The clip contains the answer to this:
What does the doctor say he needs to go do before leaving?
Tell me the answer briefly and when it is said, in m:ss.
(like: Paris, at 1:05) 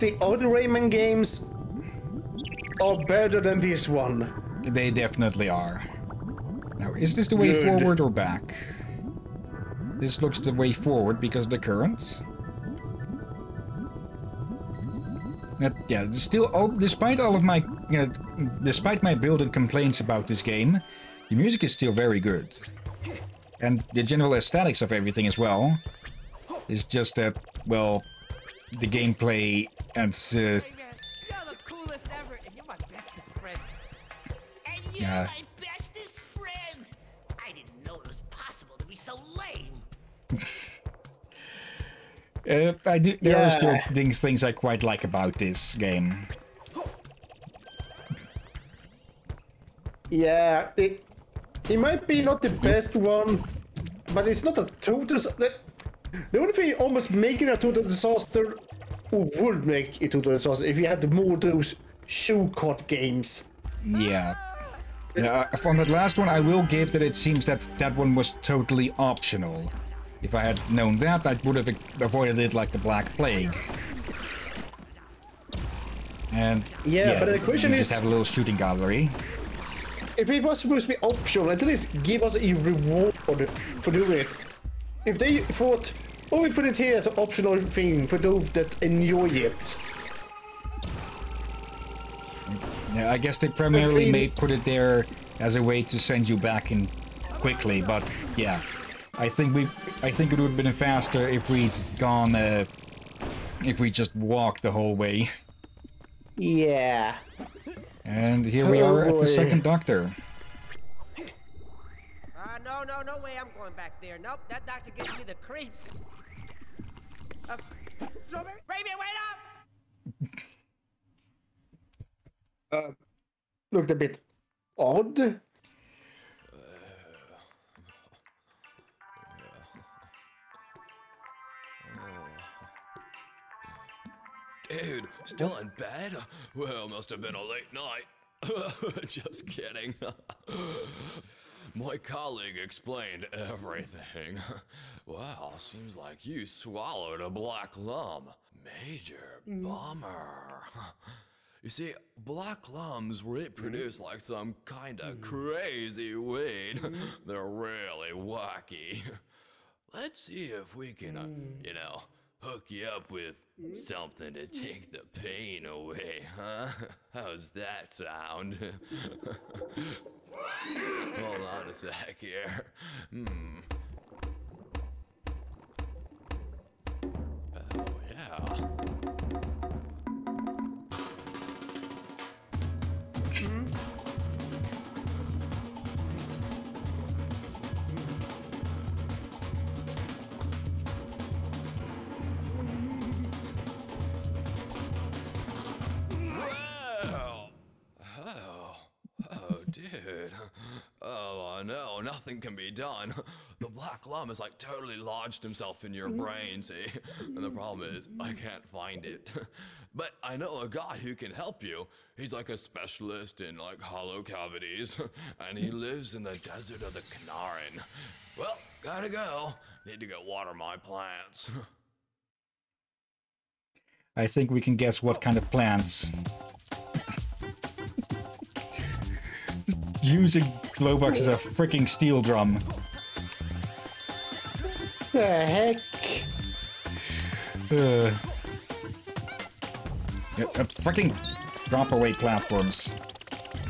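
water my plants, at 3:40.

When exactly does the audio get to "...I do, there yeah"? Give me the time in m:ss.
0:42.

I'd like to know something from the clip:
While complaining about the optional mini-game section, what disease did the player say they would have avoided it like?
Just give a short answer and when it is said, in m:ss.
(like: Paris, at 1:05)
Black Plague, at 1:12.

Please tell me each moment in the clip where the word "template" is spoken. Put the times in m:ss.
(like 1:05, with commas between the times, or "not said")
not said.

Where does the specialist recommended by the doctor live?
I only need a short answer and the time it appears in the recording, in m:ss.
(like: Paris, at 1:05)
desert of the Knaaren, at 3:36.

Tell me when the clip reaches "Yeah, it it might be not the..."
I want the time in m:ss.
0:50.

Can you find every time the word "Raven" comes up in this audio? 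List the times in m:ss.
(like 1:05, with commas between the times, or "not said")
1:58.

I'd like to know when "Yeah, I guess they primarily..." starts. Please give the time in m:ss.
1:32.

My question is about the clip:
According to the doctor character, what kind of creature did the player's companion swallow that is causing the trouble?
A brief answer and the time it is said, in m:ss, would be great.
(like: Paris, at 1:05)
black lum, at 2:27.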